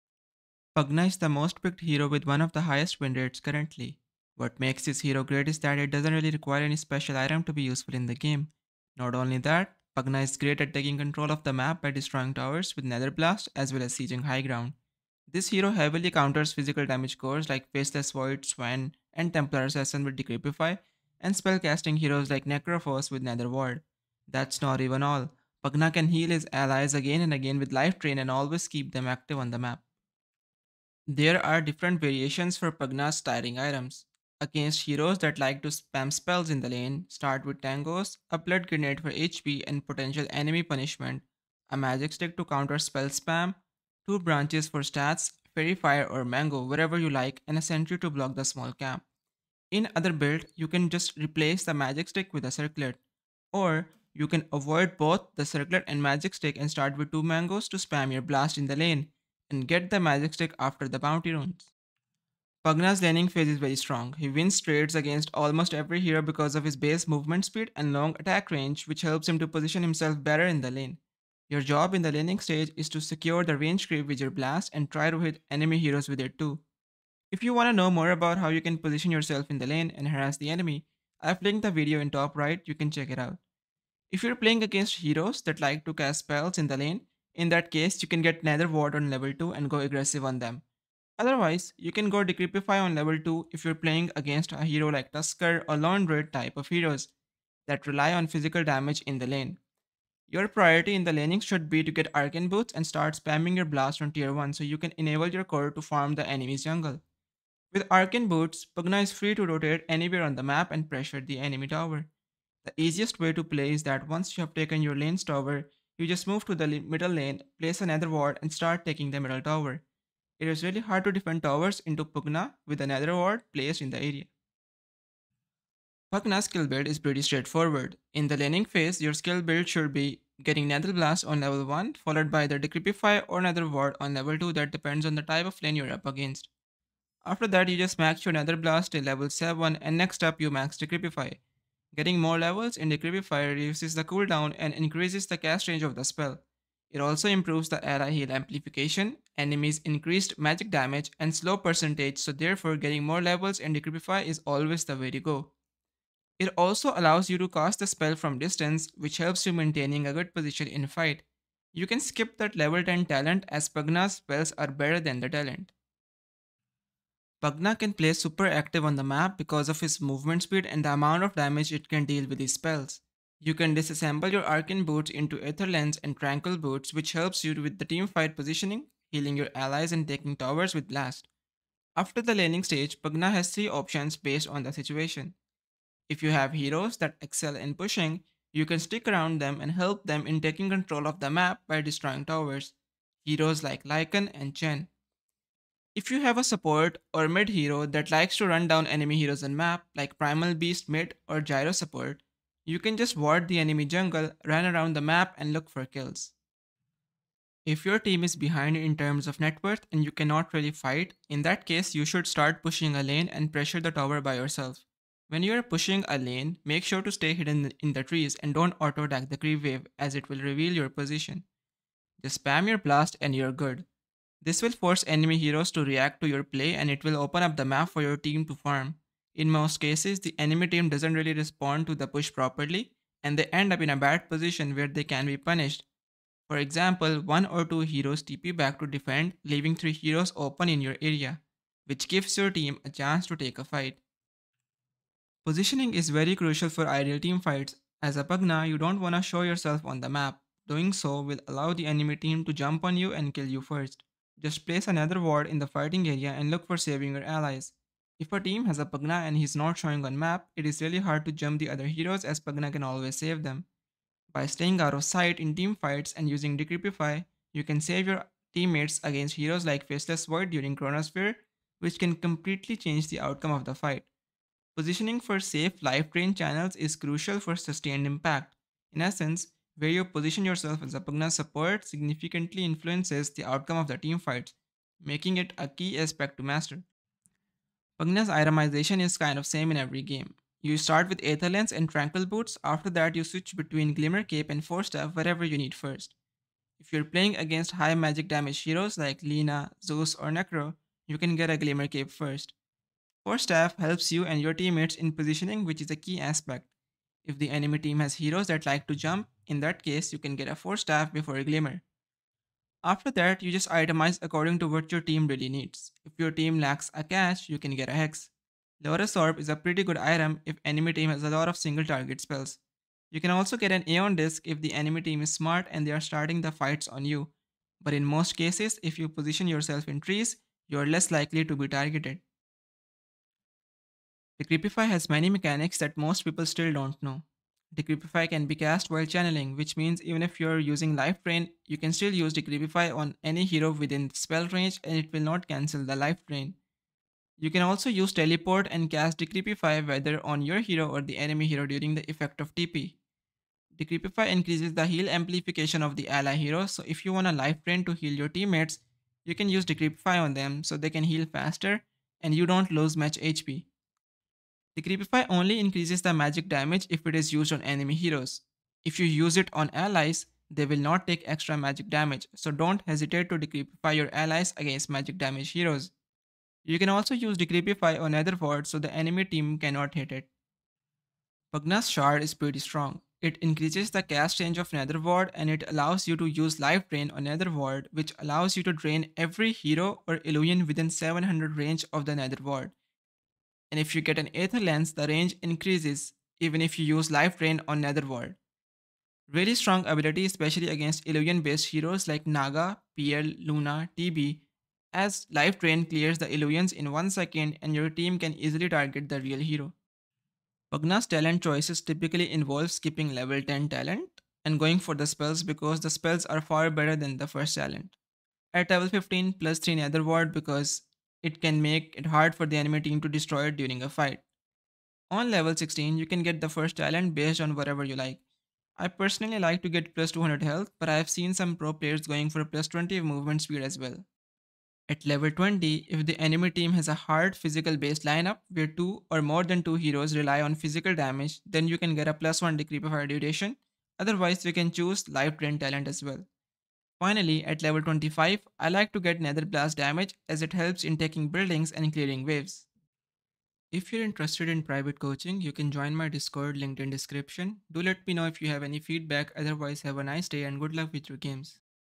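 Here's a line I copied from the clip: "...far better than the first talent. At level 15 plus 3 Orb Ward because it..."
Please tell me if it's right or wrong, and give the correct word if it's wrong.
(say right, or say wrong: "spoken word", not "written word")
wrong: "Nether", not "Orb".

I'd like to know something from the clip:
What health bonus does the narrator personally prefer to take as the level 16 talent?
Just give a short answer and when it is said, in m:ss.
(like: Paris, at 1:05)
+200 health, at 7:09.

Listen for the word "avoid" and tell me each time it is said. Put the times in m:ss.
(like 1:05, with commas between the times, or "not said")
0:54.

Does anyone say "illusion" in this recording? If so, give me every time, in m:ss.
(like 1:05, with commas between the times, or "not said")
6:30, 6:41, 6:46.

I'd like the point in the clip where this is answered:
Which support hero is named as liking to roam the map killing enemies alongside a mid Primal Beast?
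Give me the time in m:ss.
3:21.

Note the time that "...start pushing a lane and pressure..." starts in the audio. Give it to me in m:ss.
3:32.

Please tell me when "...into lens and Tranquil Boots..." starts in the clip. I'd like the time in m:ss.
2:55.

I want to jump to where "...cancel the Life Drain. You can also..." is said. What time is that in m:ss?
5:45.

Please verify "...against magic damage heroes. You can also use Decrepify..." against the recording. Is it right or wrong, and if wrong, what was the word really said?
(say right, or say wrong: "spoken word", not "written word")
right.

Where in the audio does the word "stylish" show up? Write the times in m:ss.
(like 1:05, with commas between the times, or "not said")
not said.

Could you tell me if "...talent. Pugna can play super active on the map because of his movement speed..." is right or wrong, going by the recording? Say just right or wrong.
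right.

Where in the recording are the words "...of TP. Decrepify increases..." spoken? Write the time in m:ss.
5:52.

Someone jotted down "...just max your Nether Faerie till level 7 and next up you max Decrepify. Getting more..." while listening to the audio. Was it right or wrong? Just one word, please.
wrong.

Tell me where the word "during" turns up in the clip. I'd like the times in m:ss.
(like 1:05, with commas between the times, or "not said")
4:30, 5:51, 7:03.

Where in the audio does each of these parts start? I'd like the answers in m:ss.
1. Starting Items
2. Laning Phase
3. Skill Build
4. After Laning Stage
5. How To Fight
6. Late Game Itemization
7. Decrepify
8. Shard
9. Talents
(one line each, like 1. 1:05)
1. 0:30
2. 1:01
3. 2:06
4. 2:47
5. 4:04
6. 4:47
7. 5:34
8. 6:21
9. 6:51.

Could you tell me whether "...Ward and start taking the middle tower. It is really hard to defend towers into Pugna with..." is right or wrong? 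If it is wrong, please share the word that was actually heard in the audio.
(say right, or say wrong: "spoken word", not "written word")
right.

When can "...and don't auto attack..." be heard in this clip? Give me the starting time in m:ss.
3:38.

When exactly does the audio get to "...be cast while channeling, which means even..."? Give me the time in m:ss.
5:38.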